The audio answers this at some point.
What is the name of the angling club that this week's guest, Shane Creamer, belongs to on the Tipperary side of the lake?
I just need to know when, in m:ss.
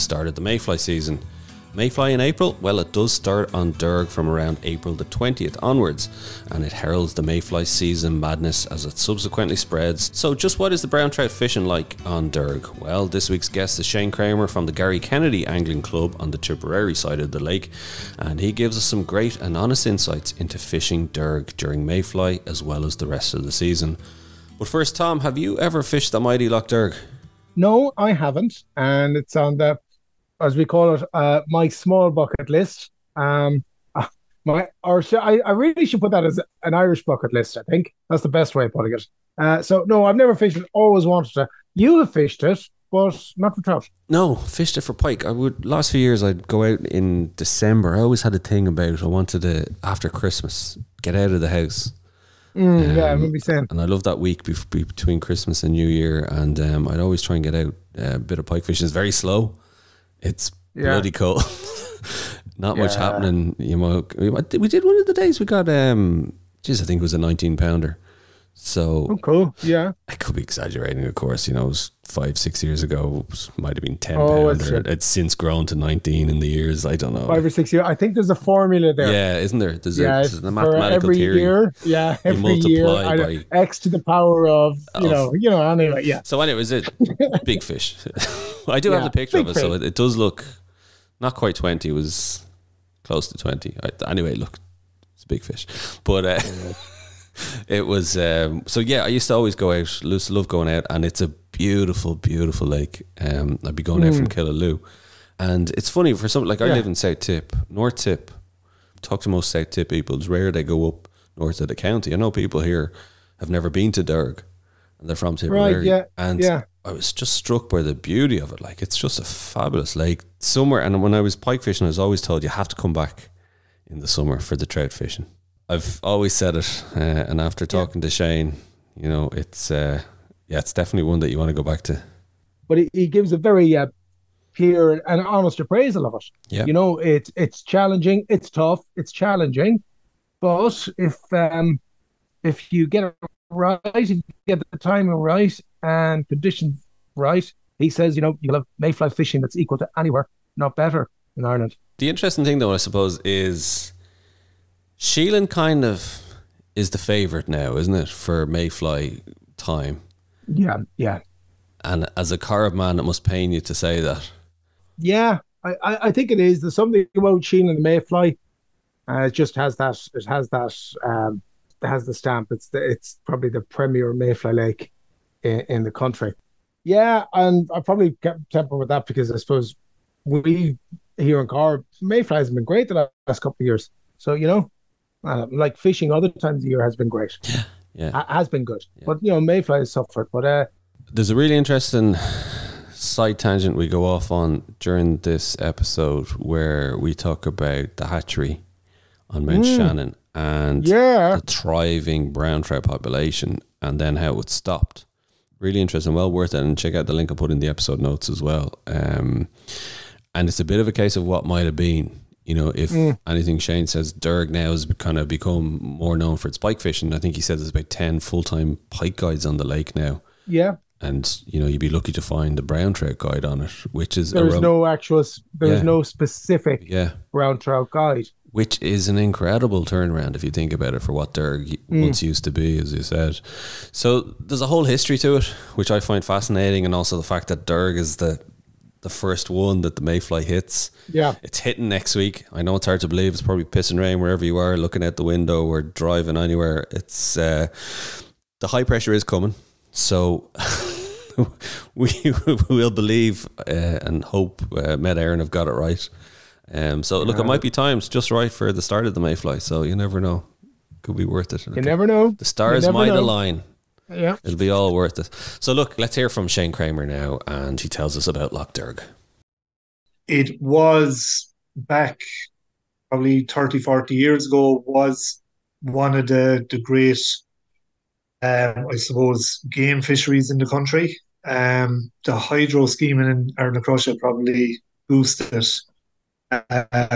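0:14.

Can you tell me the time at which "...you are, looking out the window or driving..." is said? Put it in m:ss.
4:04.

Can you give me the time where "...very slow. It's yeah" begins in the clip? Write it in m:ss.
0:58.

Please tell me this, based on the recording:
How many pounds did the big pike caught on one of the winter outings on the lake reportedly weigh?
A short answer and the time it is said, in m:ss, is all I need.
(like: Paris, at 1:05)
19, at 1:07.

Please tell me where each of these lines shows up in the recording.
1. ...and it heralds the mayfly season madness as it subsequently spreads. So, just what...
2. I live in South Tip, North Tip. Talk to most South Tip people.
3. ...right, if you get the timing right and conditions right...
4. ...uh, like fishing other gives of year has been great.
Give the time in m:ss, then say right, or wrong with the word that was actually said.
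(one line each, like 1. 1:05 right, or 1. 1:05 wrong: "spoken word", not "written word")
1. 0:06 right
2. 1:46 right
3. 2:23 right
4. 3:05 wrong: "times", not "gives".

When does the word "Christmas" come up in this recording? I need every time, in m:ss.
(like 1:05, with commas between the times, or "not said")
0:50, 0:55.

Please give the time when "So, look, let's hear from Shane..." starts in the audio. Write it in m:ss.
4:25.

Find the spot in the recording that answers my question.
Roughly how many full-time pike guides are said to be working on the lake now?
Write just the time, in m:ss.
3:37.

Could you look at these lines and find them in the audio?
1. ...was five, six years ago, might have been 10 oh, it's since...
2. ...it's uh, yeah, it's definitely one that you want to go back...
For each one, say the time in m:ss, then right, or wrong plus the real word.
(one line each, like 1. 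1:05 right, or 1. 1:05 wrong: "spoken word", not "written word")
1. 1:11 right
2. 2:09 right.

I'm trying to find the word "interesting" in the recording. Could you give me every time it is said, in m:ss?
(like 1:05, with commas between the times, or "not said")
2:32, 3:11, 3:25.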